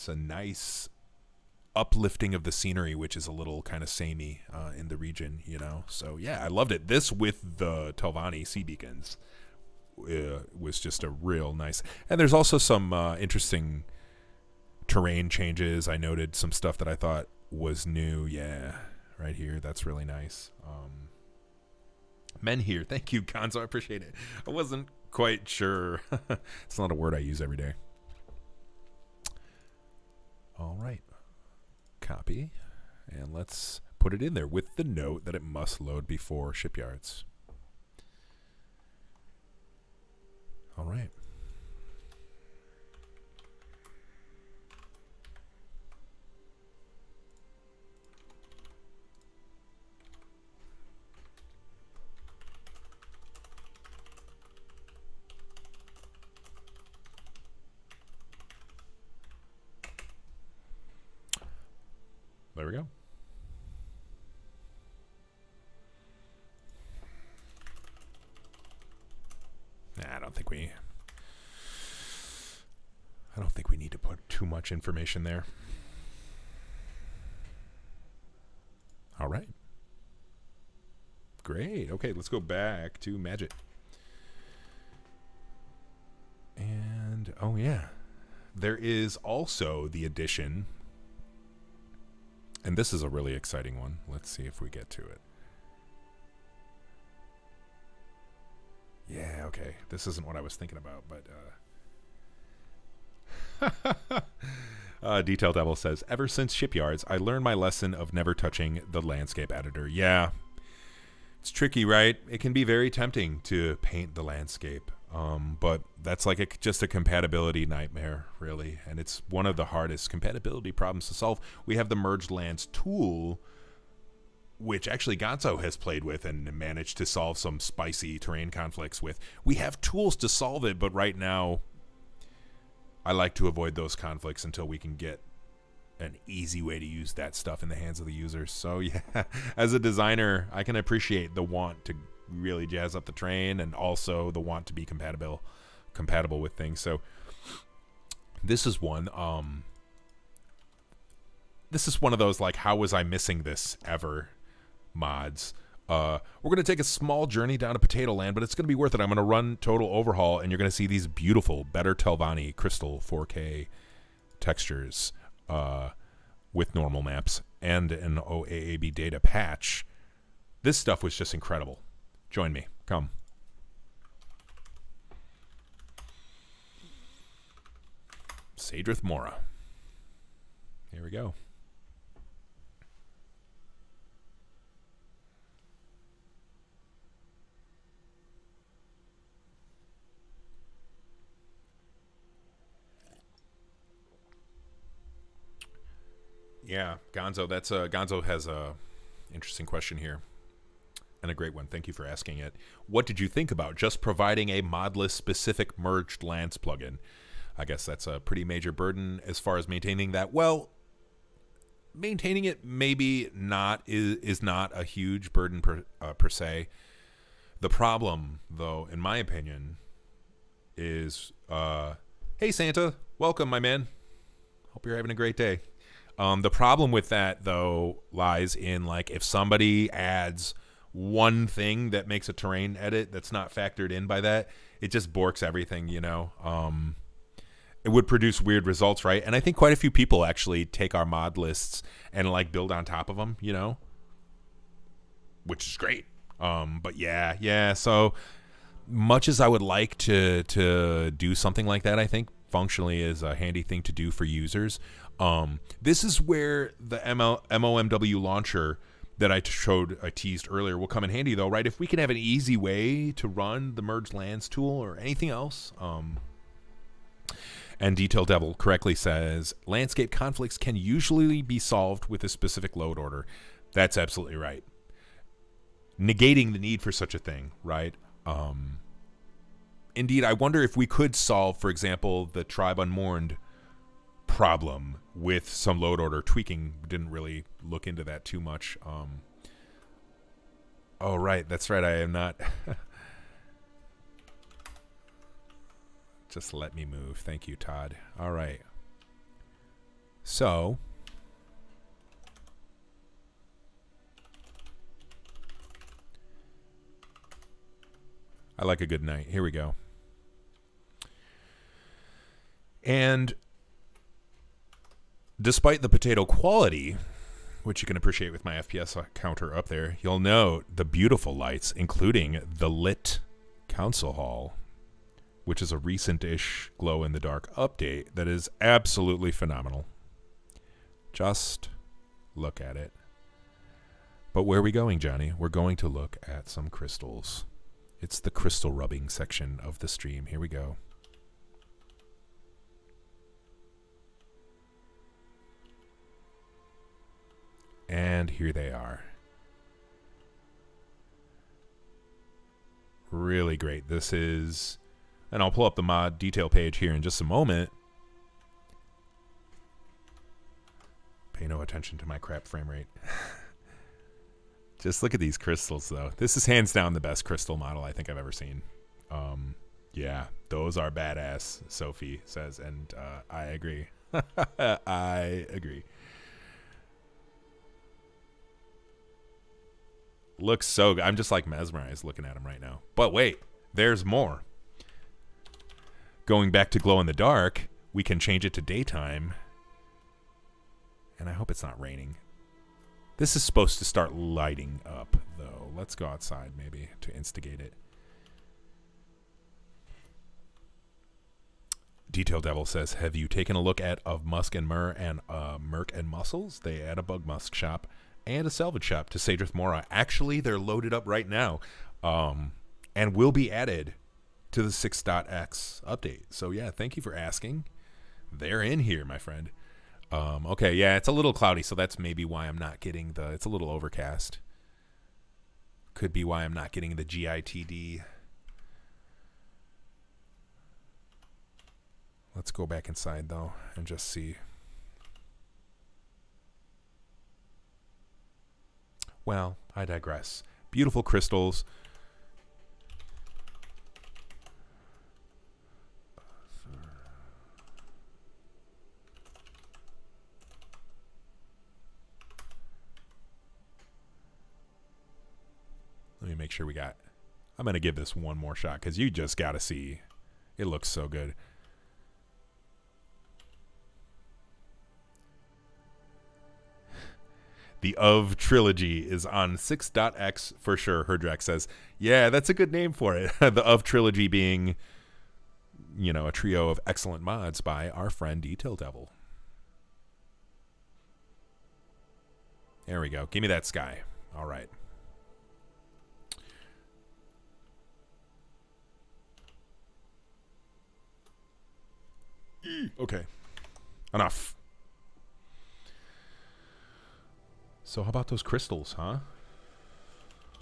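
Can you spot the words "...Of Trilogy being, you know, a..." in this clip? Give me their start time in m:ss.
7:53.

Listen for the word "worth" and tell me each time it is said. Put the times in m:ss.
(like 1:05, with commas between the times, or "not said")
2:38.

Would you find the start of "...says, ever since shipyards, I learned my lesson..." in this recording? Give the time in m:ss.
1:45.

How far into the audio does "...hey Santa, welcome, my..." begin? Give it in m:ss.
3:42.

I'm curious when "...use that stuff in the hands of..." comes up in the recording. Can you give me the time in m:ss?
2:16.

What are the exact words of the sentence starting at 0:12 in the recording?
And there's also some uh, interesting terrain changes.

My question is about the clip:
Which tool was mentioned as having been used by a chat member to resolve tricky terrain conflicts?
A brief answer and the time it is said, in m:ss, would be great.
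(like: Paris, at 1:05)
merged lands tool, at 2:01.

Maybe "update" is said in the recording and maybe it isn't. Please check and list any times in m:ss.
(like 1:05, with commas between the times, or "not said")
5:27, 6:55.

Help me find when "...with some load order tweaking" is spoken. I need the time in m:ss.
4:45.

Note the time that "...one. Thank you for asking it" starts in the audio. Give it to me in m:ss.
3:21.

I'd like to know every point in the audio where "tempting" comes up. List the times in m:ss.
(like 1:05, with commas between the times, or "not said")
1:52.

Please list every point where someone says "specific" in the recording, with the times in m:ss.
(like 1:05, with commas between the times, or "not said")
3:25, 4:32.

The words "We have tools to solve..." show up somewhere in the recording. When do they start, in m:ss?
2:09.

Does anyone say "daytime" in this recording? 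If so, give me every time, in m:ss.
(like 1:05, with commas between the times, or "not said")
6:28.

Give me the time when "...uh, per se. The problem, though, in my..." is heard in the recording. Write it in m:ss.
3:35.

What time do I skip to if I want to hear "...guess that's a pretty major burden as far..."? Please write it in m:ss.
3:27.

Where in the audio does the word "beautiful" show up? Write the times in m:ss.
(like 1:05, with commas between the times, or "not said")
2:41, 5:20, 7:20.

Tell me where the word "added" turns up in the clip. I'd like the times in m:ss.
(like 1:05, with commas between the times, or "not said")
6:53.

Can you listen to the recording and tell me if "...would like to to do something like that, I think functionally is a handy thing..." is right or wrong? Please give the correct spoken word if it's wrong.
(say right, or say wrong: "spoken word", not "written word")
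right.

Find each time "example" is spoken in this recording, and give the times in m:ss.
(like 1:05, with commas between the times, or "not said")
4:41.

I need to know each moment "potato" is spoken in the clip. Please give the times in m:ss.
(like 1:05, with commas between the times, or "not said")
2:37, 5:15.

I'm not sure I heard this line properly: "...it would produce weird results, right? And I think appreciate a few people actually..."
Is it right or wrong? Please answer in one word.
wrong.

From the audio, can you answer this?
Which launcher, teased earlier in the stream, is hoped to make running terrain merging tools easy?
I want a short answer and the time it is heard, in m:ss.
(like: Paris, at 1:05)
MOMW launcher, at 4:17.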